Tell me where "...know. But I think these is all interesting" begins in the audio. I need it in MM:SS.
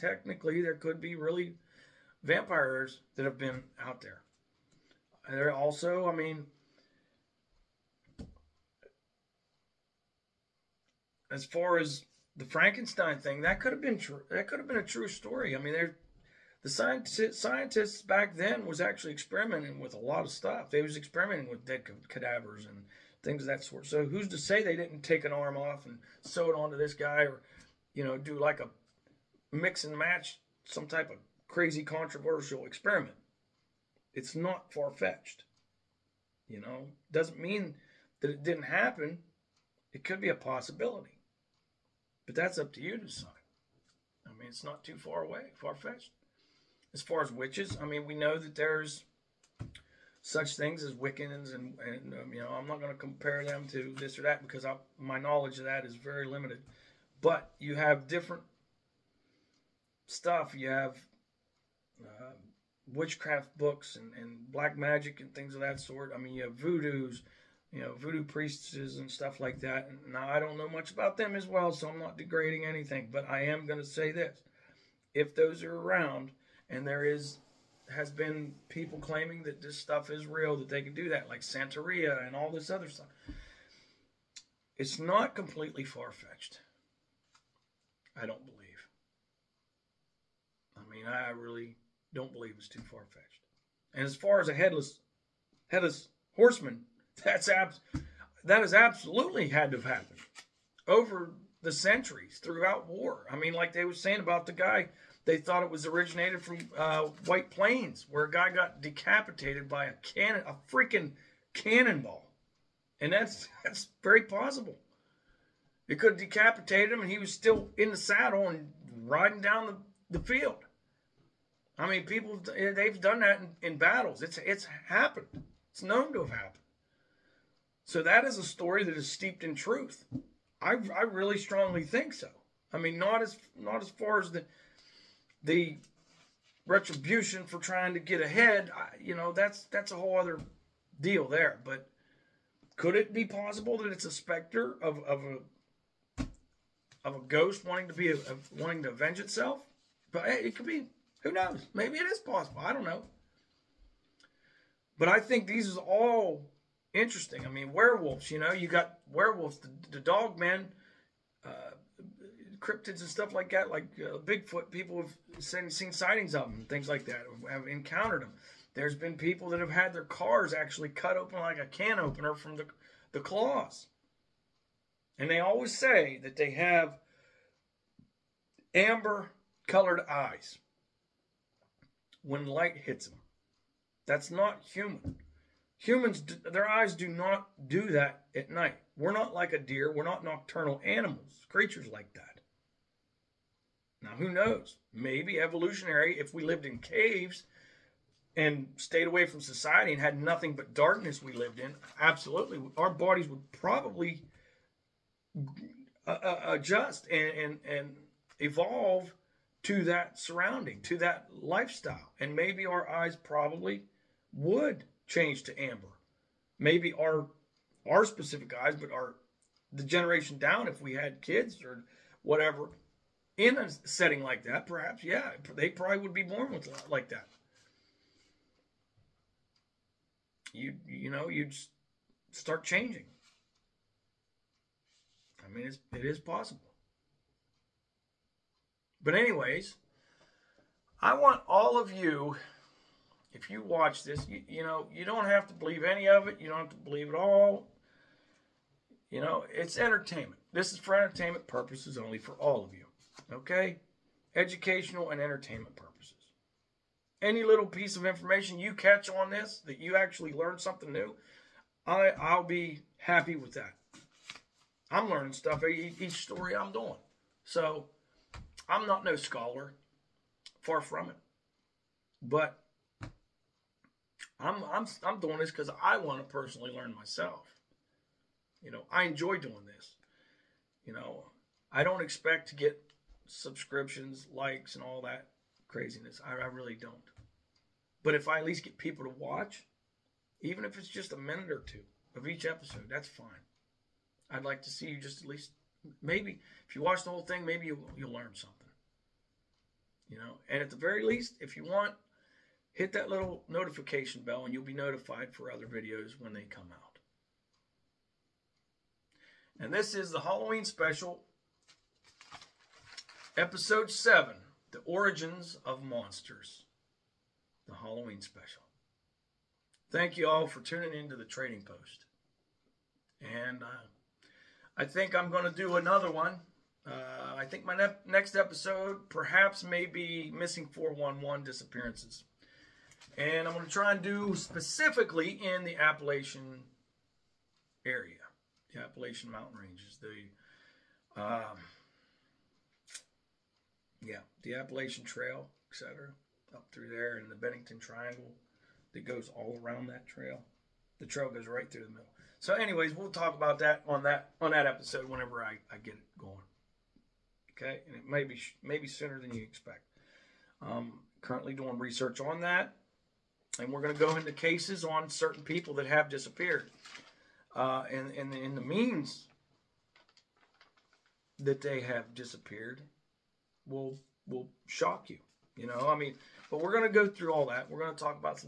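02:32.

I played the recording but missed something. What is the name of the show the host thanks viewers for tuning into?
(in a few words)
The Trading Post.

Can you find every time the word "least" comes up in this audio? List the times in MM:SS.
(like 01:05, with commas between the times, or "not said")
04:48, 04:55, 05:01.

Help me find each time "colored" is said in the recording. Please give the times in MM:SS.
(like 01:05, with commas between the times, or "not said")
02:59.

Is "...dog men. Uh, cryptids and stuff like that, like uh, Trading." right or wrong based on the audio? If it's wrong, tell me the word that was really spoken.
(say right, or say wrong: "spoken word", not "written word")
wrong: "Bigfoot", not "Trading".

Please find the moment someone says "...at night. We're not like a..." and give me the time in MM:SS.
03:08.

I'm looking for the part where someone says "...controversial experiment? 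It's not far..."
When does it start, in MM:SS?
00:31.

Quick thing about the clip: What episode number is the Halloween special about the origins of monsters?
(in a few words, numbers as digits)
7.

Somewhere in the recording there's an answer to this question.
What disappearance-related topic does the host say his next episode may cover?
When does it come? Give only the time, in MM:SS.
05:30.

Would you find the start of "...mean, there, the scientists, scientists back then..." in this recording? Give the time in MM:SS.
00:15.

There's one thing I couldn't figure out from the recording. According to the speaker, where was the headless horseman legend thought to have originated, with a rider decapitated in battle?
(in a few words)
White Plains.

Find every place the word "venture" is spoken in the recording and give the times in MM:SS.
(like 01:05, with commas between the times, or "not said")
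not said.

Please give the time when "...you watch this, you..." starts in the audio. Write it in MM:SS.
04:03.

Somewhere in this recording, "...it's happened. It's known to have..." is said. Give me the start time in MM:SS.
02:04.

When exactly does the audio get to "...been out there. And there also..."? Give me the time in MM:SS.
00:03.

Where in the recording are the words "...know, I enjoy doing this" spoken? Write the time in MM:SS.
04:38.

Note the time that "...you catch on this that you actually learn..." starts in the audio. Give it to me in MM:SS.
04:18.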